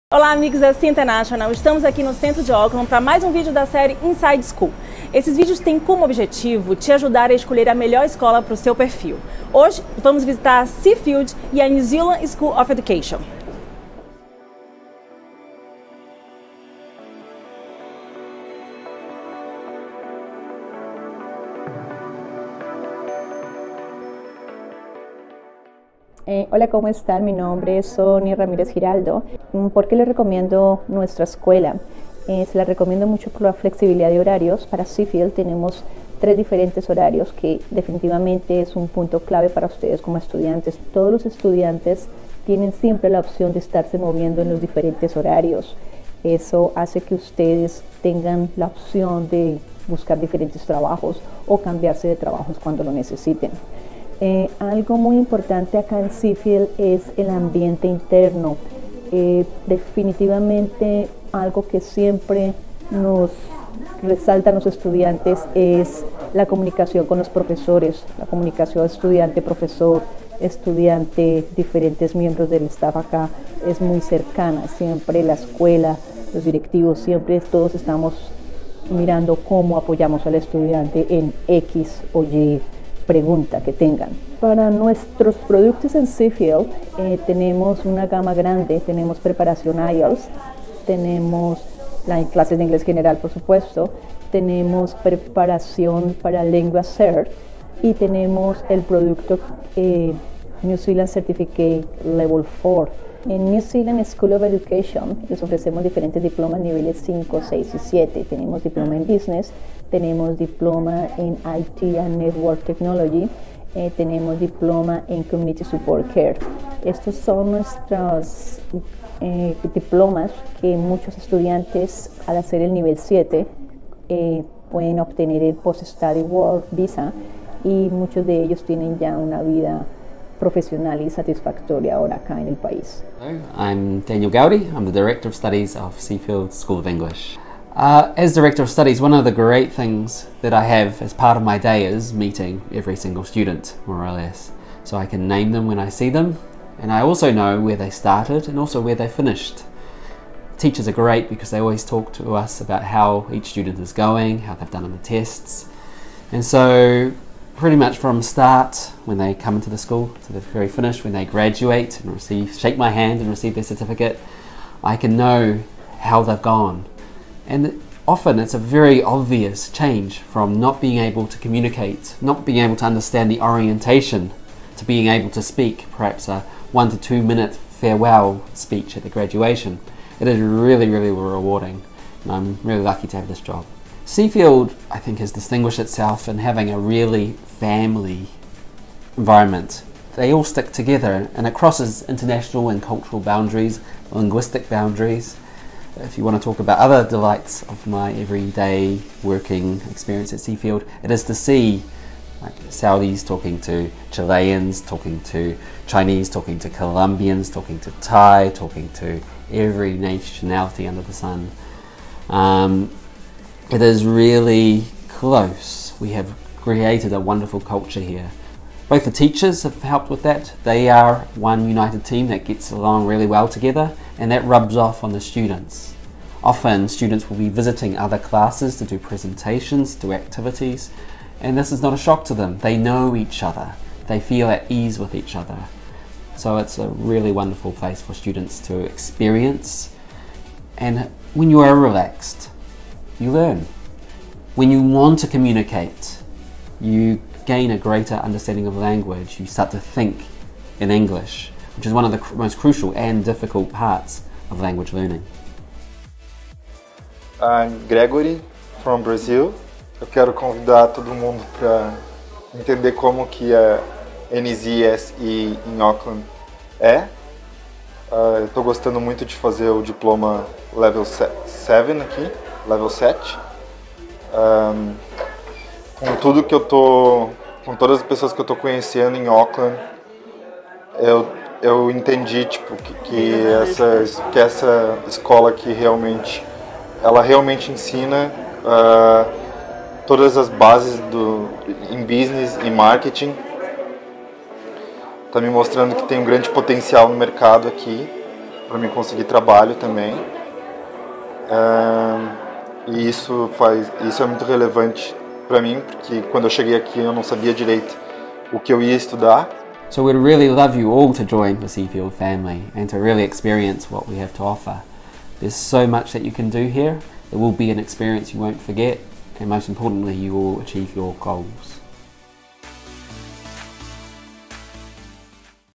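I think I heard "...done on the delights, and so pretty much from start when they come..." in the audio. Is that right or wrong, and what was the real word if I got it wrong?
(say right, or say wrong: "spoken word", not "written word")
wrong: "tests", not "delights".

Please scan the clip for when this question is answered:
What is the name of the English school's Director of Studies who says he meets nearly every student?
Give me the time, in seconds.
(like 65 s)
134 s.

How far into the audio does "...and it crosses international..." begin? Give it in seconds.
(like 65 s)
191 s.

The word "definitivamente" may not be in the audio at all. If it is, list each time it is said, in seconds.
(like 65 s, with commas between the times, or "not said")
37 s, 59 s.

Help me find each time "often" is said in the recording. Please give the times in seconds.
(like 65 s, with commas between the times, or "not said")
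168 s, 226 s.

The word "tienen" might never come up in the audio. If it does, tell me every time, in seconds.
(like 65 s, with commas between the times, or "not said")
42 s, 128 s.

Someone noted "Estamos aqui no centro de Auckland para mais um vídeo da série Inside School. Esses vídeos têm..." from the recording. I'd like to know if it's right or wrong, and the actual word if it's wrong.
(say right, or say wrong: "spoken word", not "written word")
right.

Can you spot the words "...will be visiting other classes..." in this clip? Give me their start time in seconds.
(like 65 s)
227 s.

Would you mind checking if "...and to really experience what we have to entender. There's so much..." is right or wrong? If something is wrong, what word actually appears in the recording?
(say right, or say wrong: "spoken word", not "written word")
wrong: "offer", not "entender".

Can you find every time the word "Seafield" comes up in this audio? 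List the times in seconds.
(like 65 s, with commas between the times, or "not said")
10 s, 34 s, 56 s, 86 s, 135 s, 184 s, 200 s, 311 s.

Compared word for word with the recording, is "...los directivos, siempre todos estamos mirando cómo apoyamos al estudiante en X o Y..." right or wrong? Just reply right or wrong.
right.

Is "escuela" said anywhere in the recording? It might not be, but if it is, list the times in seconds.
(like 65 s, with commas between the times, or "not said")
31 s, 75 s.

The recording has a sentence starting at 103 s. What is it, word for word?
En New Zealand School of Education les ofrecemos diferentes diplomas niveles 5, 6 y 7.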